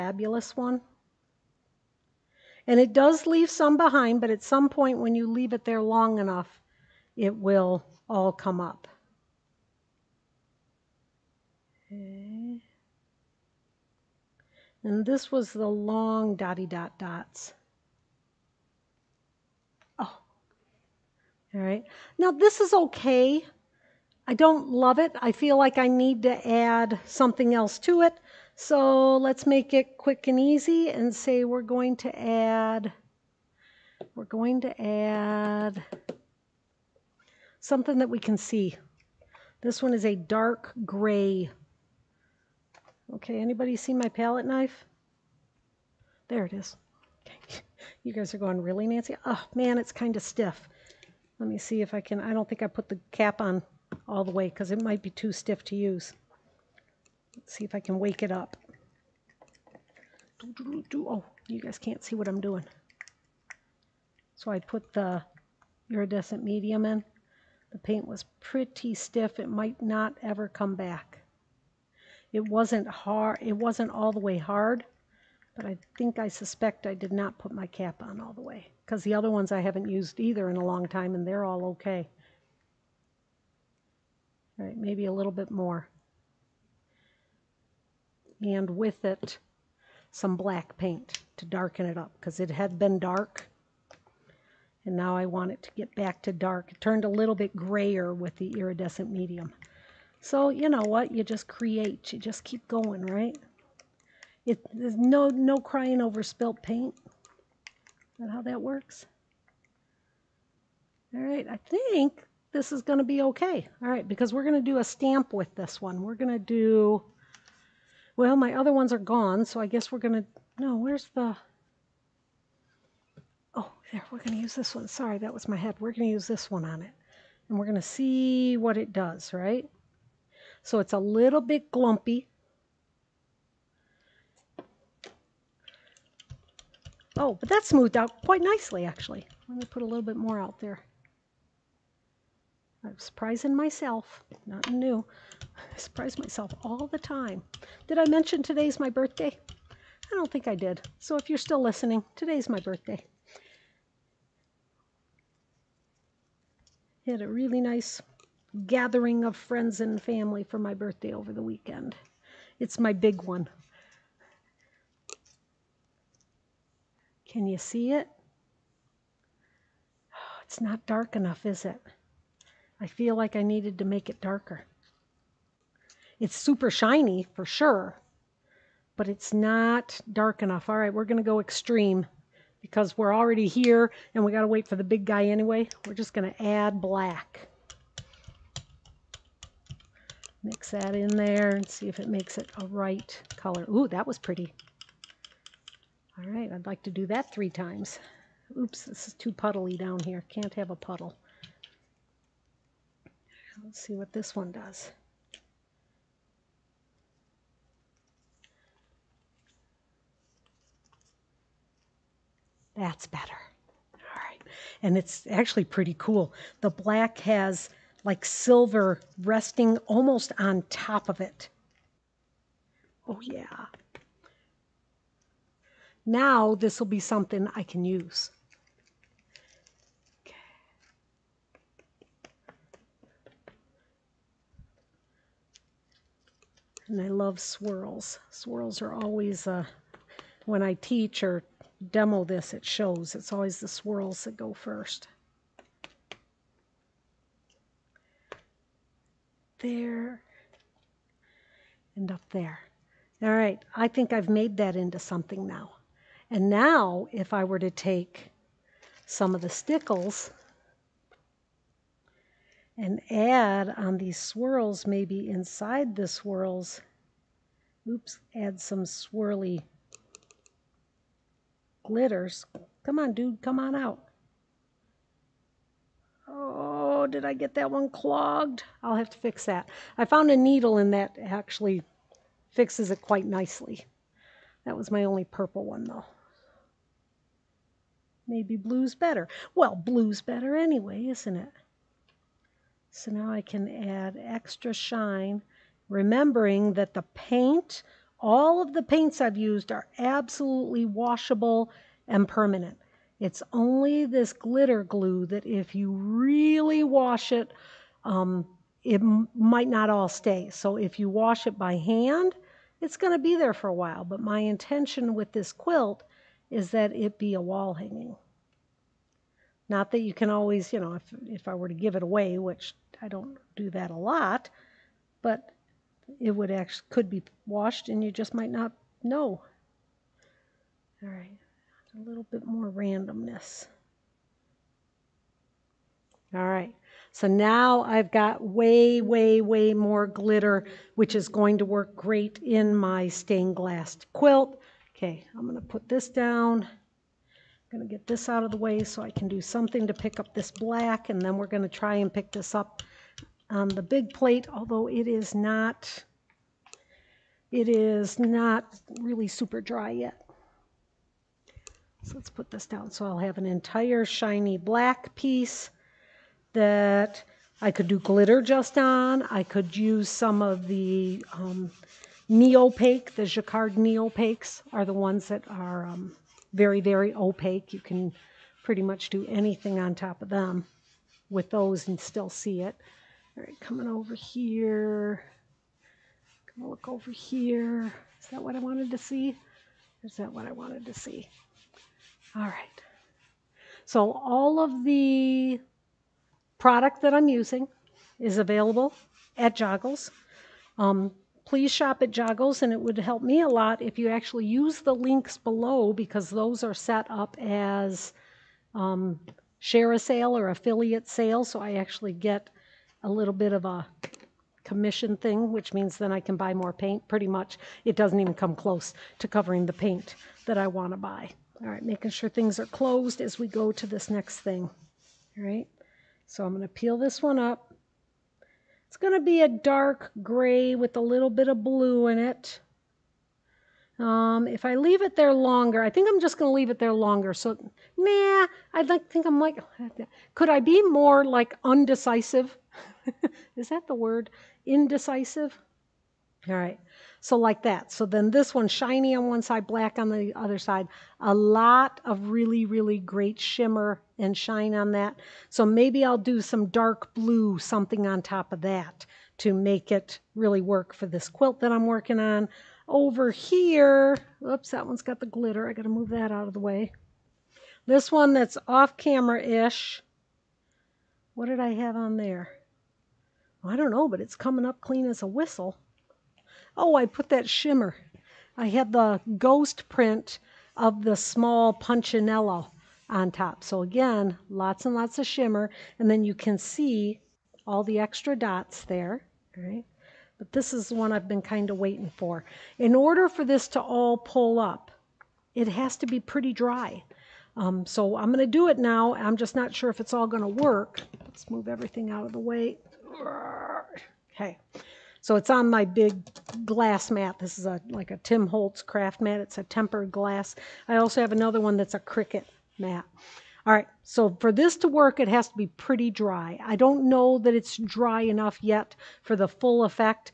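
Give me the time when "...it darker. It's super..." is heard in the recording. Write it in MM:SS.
02:54.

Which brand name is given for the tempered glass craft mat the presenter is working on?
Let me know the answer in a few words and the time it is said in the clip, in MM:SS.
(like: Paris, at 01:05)
Tim Holtz, at 08:28.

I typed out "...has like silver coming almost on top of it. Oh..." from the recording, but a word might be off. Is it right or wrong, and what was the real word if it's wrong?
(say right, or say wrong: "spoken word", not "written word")
wrong: "resting", not "coming".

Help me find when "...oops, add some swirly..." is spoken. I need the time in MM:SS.
04:27.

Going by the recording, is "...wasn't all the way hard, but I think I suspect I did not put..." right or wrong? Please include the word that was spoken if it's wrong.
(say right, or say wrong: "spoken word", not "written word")
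right.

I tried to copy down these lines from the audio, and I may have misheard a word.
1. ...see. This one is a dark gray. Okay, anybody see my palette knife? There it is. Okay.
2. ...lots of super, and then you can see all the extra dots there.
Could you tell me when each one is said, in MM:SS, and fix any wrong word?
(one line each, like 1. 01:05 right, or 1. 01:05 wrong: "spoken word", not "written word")
1. 00:38 right
2. 08:04 wrong: "shimmer", not "super".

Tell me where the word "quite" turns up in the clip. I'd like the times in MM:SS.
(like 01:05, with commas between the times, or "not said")
02:18, 04:43.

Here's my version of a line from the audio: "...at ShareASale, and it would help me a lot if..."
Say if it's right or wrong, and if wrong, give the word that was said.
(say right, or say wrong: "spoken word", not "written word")
wrong: "Joggles", not "ShareASale".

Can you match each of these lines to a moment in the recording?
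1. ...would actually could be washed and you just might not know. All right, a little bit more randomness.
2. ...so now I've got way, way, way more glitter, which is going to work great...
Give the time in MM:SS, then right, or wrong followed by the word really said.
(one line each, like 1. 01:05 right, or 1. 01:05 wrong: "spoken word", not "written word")
1. 05:26 right
2. 05:37 right.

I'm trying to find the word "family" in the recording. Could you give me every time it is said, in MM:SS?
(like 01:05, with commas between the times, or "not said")
02:40.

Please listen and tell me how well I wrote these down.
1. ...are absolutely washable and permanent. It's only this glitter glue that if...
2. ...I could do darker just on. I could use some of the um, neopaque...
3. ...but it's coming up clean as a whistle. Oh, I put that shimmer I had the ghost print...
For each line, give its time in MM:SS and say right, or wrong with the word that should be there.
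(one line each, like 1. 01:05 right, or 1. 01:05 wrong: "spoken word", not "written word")
1. 04:59 right
2. 06:07 wrong: "glitter", not "darker"
3. 07:54 right.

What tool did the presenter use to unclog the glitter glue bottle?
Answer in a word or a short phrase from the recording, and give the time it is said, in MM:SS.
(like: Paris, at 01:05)
A needle, at 04:40.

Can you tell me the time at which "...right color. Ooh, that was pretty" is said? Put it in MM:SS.
03:12.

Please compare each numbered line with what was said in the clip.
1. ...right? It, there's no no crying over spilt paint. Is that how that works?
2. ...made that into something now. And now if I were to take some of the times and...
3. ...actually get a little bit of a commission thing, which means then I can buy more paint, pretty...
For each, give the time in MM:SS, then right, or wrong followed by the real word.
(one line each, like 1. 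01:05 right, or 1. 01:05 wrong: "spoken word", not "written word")
1. 01:43 right
2. 04:14 wrong: "stickles", not "times"
3. 06:51 right.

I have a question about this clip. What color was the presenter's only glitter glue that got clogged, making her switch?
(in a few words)
Purple.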